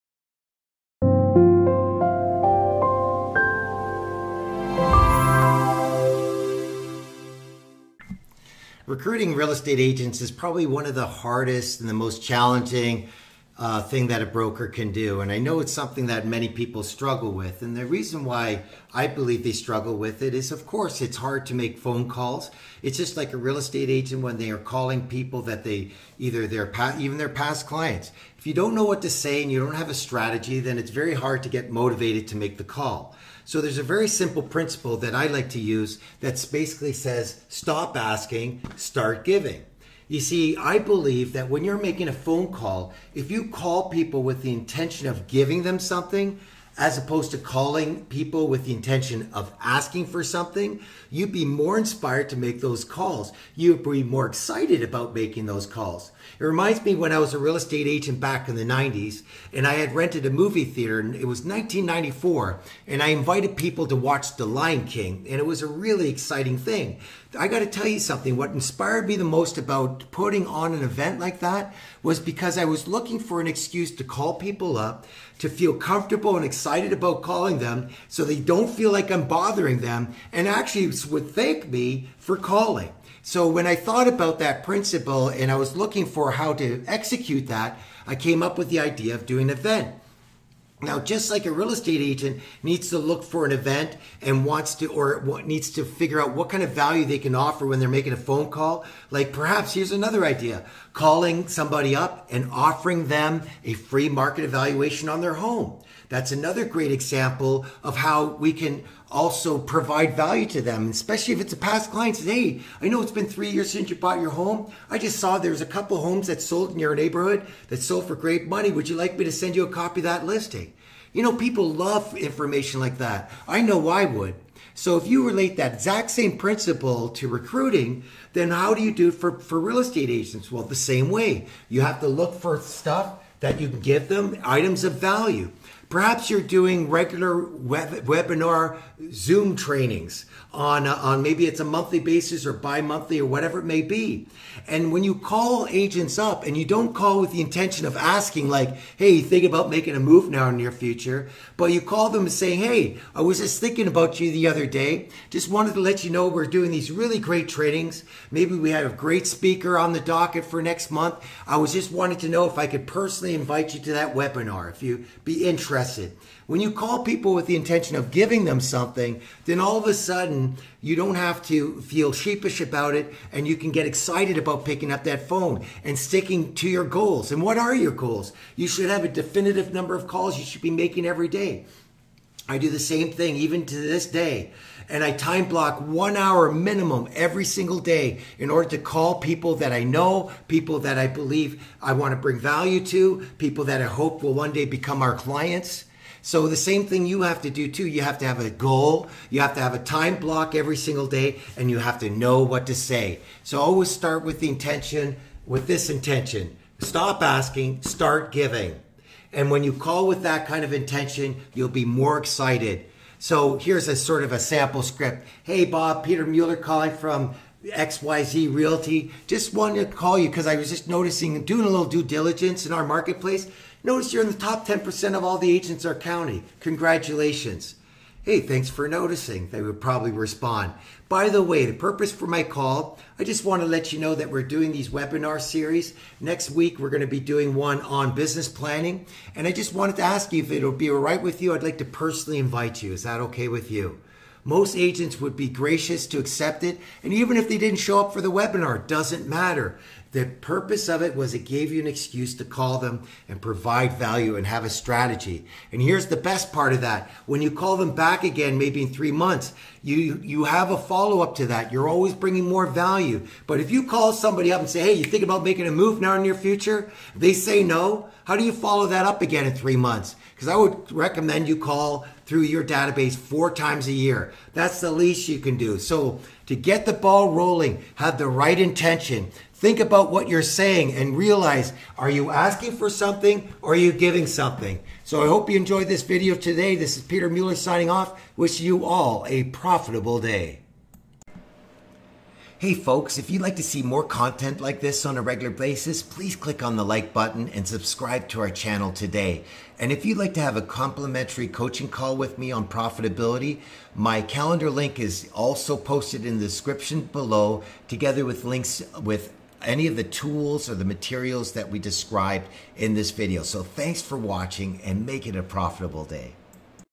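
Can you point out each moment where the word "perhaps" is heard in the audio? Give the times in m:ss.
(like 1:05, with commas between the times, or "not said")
1:39, 2:15.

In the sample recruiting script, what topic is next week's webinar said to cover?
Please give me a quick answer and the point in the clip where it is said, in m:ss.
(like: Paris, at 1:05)
Business planning, at 3:58.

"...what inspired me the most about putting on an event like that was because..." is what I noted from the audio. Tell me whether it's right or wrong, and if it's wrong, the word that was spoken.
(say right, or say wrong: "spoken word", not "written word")
right.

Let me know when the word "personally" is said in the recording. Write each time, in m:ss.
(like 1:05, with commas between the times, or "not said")
2:42, 4:01.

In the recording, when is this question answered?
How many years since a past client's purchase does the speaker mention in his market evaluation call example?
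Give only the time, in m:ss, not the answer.
1:53.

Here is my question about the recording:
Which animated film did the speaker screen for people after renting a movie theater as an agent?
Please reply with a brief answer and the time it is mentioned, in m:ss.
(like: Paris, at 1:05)
The Lion King, at 1:04.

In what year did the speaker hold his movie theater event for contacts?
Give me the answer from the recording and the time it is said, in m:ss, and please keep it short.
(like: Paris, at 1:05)
1994, at 1:01.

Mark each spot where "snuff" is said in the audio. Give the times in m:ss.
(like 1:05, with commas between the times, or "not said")
not said.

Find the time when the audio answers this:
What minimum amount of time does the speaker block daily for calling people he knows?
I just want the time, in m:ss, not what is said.
3:05.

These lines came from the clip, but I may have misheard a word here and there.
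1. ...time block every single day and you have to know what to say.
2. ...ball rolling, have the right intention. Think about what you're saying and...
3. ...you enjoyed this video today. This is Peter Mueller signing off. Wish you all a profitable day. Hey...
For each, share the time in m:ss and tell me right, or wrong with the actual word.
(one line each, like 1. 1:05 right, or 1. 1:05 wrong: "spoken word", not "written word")
1. 3:19 right
2. 4:36 right
3. 4:45 right.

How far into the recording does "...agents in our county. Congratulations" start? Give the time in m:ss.
3:45.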